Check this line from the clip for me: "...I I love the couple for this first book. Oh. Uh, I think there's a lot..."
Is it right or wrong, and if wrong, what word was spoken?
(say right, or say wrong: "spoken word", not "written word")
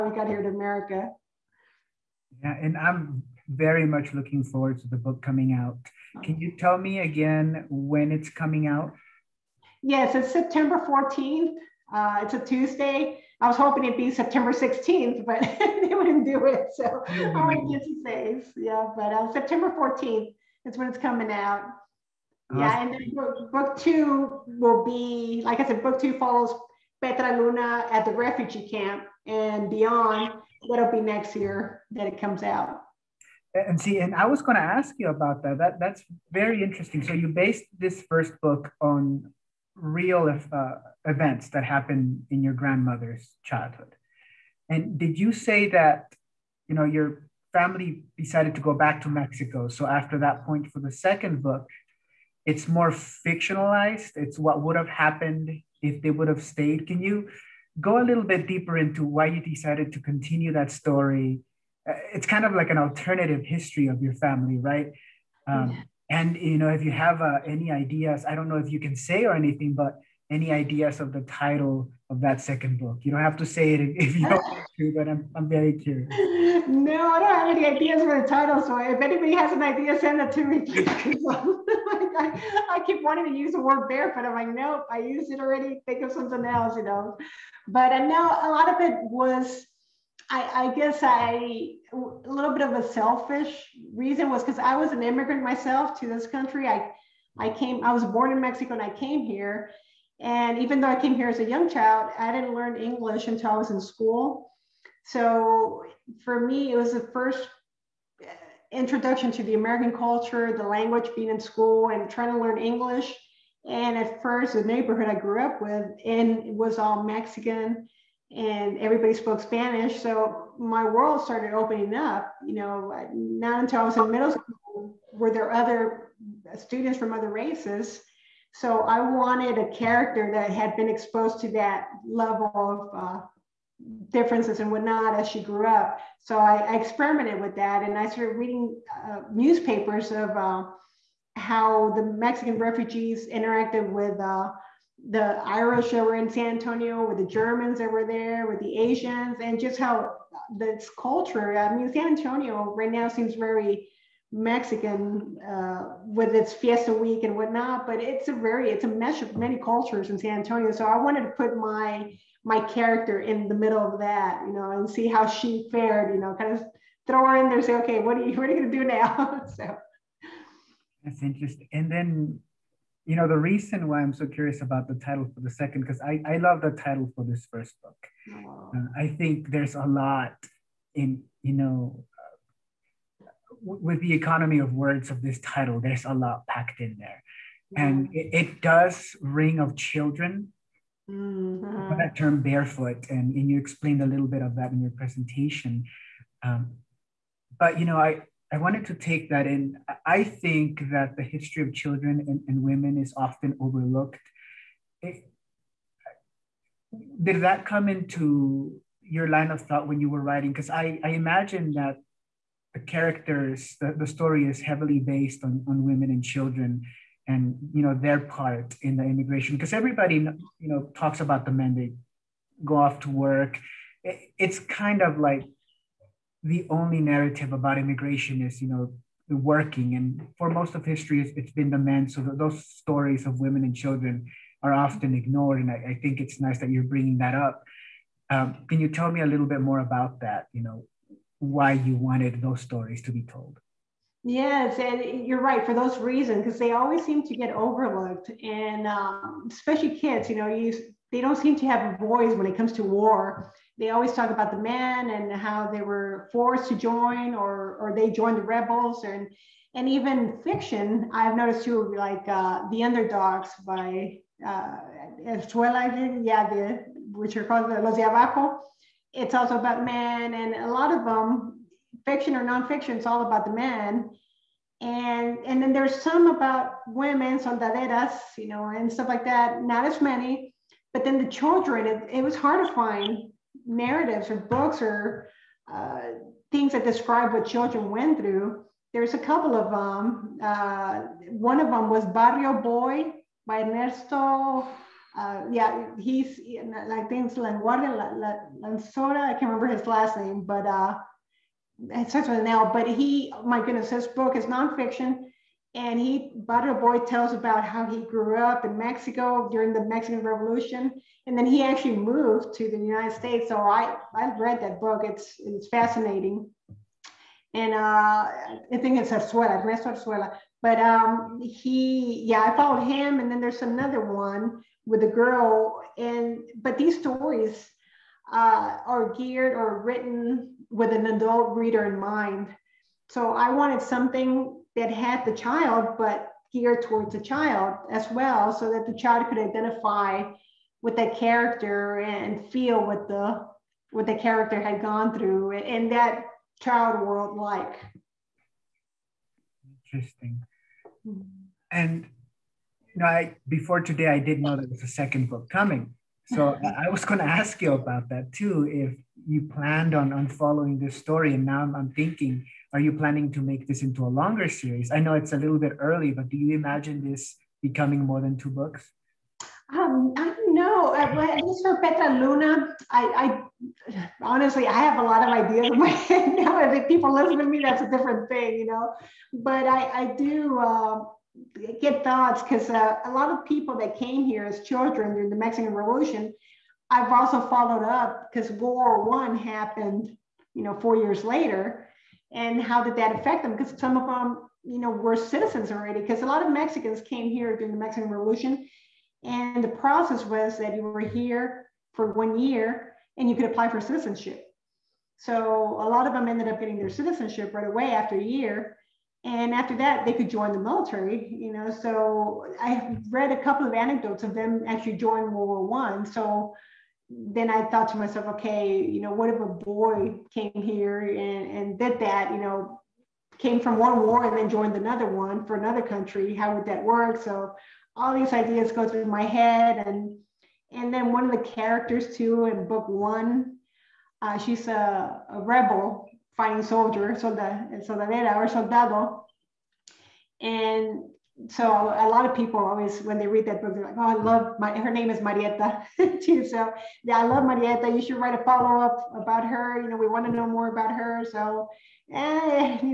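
wrong: "title", not "couple".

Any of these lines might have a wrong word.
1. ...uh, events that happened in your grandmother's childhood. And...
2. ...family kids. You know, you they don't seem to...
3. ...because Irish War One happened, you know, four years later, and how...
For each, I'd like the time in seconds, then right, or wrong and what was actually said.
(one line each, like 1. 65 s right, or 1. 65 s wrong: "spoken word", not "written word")
1. 40 s right
2. 249 s wrong: "especially", not "family"
3. 388 s wrong: "World", not "Irish".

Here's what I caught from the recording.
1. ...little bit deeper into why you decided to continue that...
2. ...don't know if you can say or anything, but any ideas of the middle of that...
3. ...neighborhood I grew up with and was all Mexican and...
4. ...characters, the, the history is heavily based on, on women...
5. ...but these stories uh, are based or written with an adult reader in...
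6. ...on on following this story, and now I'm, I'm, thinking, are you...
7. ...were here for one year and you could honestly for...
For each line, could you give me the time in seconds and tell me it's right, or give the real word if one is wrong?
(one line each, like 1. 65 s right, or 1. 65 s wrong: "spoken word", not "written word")
1. 58 s right
2. 68 s wrong: "title", not "middle"
3. 114 s right
4. 212 s wrong: "story", not "history"
5. 326 s wrong: "geared", not "based"
6. 359 s right
7. 400 s wrong: "apply", not "honestly".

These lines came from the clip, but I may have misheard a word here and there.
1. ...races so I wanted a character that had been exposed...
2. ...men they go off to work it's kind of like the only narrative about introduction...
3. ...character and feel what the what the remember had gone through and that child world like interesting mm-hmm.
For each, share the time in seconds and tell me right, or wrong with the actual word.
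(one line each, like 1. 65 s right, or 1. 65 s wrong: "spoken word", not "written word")
1. 127 s right
2. 221 s wrong: "immigration", not "introduction"
3. 341 s wrong: "character", not "remember".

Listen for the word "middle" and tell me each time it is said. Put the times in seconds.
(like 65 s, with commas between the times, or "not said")
124 s, 163 s.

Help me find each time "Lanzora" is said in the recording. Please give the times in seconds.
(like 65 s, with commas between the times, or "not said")
298 s.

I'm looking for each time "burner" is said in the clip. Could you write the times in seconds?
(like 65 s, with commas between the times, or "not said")
not said.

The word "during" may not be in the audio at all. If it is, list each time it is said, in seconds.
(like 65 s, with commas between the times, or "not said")
309 s, 385 s, 397 s.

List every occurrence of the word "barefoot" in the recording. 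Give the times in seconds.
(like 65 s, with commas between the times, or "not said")
83 s, 192 s.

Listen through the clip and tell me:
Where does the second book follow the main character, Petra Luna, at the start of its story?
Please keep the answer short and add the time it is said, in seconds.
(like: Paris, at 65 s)
refugee camp, at 28 s.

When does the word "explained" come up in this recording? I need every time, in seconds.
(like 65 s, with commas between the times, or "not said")
193 s.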